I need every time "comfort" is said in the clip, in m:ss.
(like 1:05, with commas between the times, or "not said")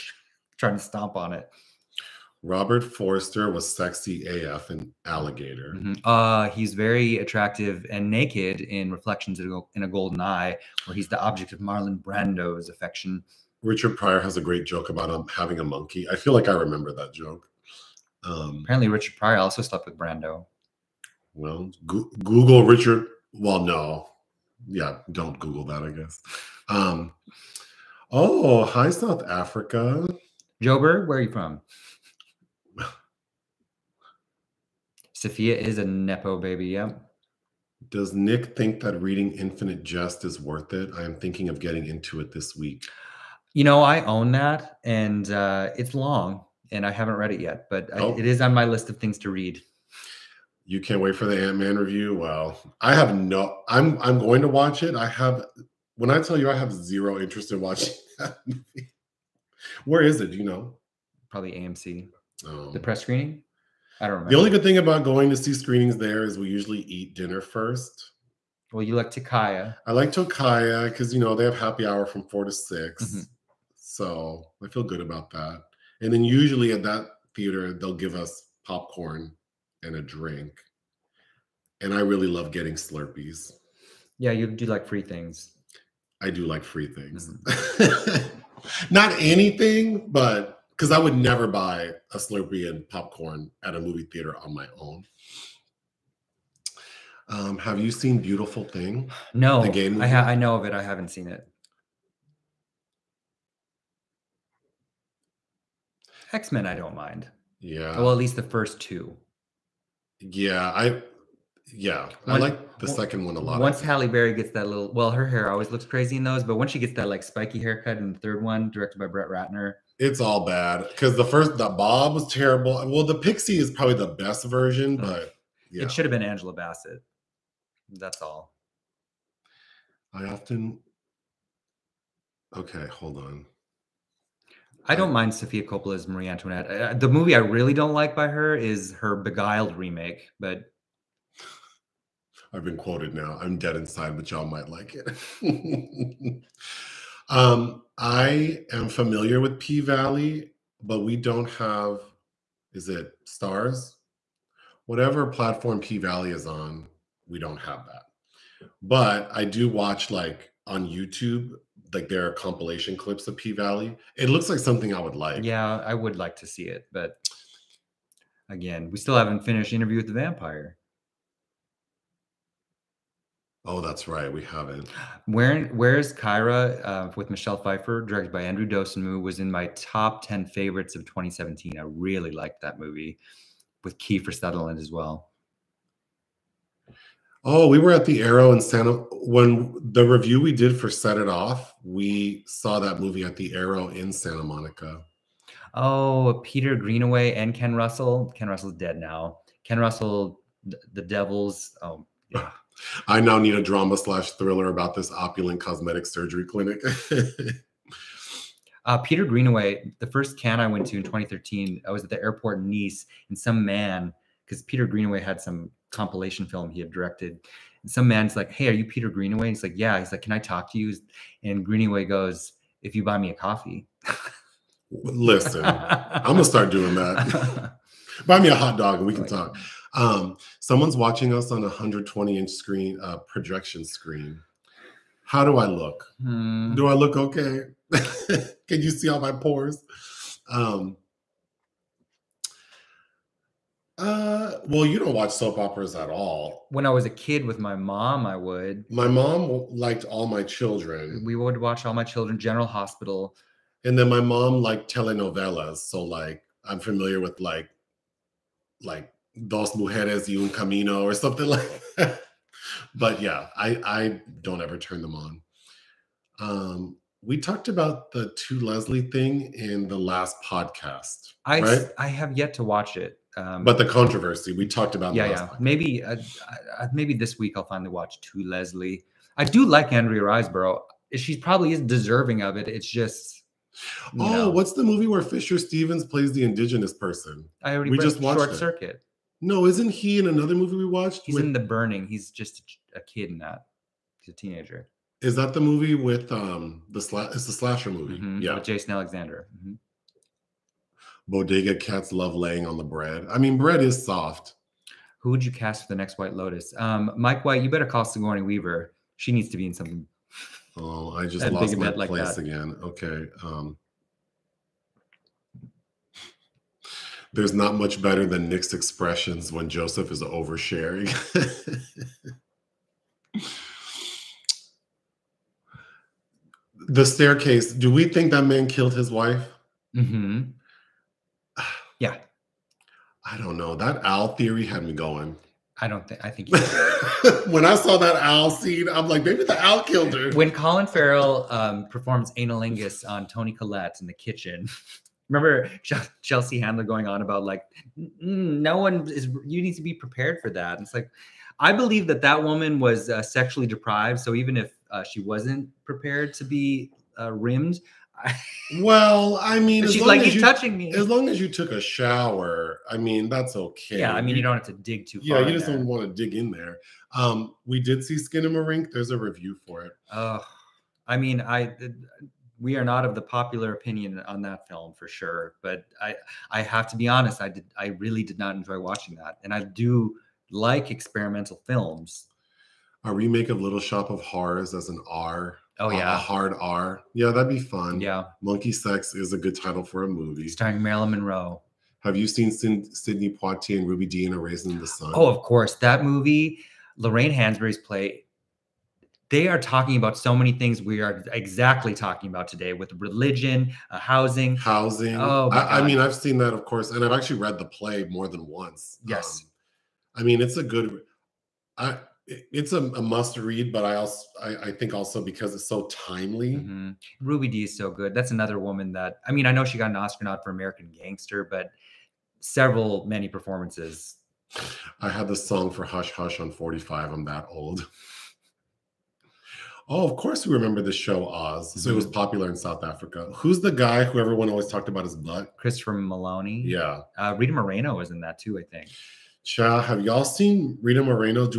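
not said.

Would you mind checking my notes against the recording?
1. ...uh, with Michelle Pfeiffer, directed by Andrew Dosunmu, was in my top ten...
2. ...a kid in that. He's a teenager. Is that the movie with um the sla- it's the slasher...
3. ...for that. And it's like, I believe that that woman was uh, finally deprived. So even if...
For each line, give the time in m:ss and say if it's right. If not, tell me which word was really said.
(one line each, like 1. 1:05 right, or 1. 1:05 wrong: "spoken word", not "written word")
1. 2:56 right
2. 4:52 right
3. 5:50 wrong: "sexually", not "finally".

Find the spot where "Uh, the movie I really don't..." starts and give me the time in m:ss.
2:16.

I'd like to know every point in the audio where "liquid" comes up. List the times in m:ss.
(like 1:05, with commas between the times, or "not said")
not said.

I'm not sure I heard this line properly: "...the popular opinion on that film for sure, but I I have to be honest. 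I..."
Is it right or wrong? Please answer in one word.
right.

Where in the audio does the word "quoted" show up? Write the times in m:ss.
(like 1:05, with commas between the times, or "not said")
2:22.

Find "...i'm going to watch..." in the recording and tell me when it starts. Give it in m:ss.
0:54.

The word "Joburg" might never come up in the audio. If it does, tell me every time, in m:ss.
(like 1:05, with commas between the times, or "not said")
0:30.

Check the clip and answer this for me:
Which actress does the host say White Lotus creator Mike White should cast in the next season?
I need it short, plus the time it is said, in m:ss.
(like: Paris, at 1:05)
Sigourney Weaver, at 5:08.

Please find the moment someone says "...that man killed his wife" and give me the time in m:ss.
5:28.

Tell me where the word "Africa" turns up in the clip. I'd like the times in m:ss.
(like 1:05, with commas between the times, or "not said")
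0:29, 7:12.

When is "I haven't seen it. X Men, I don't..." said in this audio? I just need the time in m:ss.
1:40.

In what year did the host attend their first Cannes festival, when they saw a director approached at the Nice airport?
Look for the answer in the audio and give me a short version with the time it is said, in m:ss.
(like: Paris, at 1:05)
2013, at 3:31.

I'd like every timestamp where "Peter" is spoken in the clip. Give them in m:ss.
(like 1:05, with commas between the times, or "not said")
3:16, 3:28, 3:34, 3:38.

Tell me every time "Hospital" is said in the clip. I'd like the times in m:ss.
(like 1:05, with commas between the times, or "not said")
4:12.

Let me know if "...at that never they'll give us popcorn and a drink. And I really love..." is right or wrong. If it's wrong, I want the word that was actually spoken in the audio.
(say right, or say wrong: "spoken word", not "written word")
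wrong: "theater", not "never".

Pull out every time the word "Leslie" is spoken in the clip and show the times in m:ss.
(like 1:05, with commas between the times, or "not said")
4:28, 4:38.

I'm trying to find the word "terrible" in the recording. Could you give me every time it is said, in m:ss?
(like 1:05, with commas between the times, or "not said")
2:02.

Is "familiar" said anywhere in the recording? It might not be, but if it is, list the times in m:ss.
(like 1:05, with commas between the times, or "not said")
2:28, 4:16.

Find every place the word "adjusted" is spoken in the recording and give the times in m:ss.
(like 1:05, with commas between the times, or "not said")
not said.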